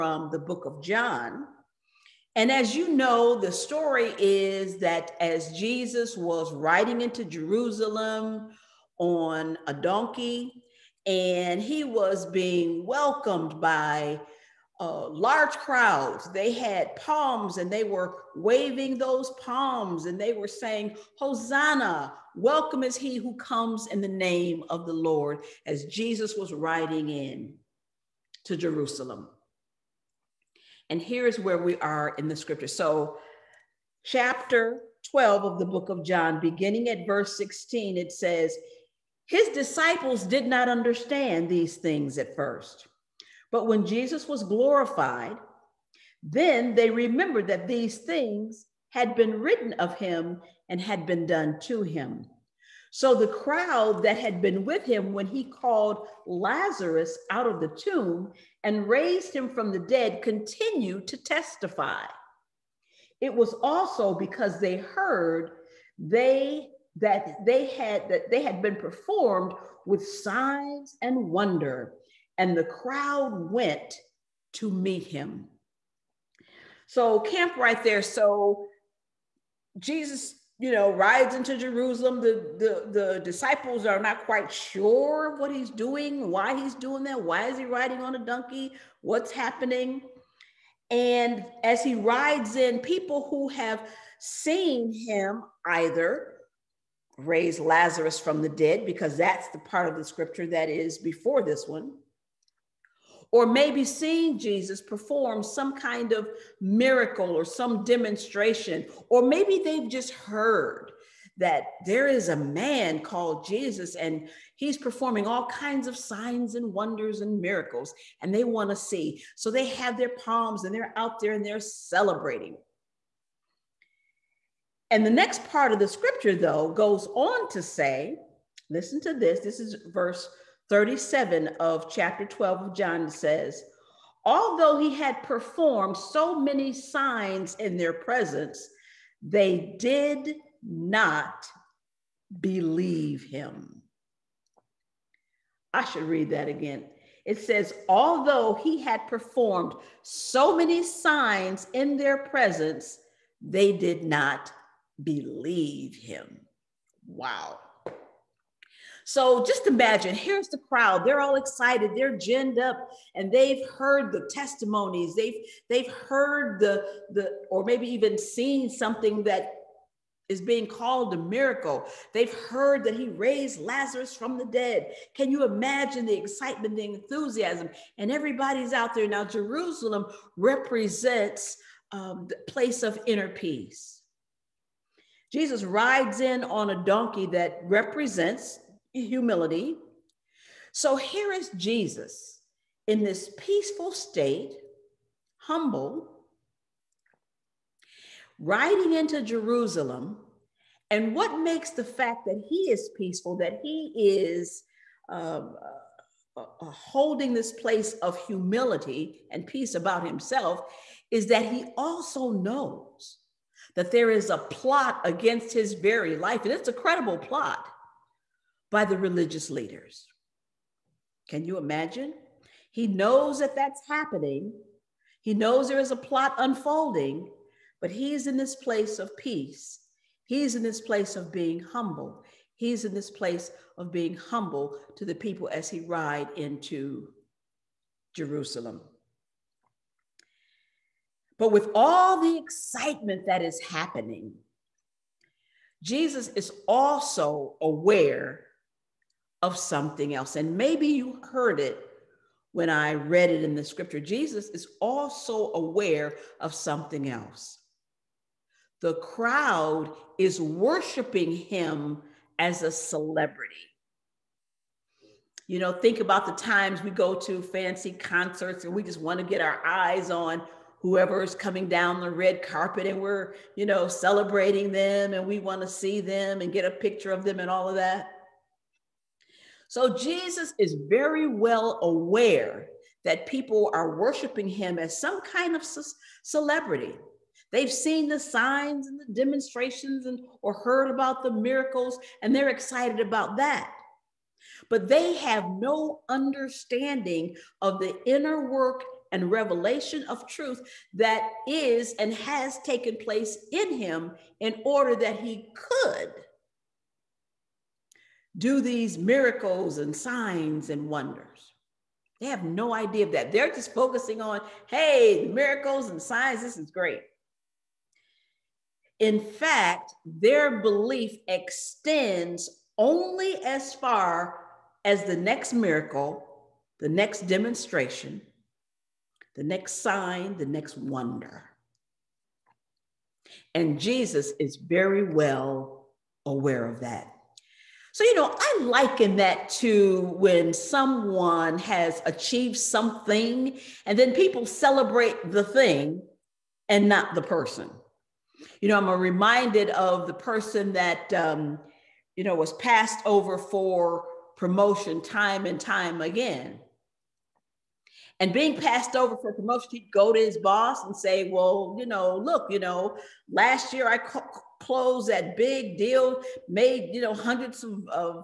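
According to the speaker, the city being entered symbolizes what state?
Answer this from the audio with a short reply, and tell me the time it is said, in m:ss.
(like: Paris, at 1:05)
inner peace, at 3:03.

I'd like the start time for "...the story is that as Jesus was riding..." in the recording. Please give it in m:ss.
0:03.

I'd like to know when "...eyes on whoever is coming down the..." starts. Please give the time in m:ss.
4:29.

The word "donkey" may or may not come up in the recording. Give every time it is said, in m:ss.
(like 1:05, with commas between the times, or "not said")
0:09, 1:28, 3:06.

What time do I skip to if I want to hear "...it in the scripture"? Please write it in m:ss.
4:13.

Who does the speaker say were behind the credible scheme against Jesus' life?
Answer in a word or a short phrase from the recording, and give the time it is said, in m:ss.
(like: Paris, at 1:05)
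the religious leaders, at 3:38.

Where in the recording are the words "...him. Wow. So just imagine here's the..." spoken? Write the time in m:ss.
2:35.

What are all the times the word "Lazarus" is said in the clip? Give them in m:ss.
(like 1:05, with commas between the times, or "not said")
0:56, 1:37, 2:53.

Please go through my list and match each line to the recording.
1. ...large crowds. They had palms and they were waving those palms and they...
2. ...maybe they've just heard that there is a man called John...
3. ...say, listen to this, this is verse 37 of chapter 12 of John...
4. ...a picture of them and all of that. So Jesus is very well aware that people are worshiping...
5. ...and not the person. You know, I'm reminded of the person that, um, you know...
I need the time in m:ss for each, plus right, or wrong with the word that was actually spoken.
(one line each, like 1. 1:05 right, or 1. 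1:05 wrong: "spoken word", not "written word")
1. 0:15 right
2. 1:49 wrong: "Jesus", not "John"
3. 2:07 right
4. 4:36 right
5. 5:46 right.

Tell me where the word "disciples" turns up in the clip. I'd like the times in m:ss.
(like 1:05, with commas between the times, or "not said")
0:39, 1:23.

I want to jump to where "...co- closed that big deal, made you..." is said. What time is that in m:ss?
6:03.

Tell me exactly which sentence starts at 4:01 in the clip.
But with all the excitement that is happening, Jesus is also aware of something else.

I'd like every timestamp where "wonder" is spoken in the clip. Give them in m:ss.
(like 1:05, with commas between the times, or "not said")
1:11, 1:56, 5:10, 5:30.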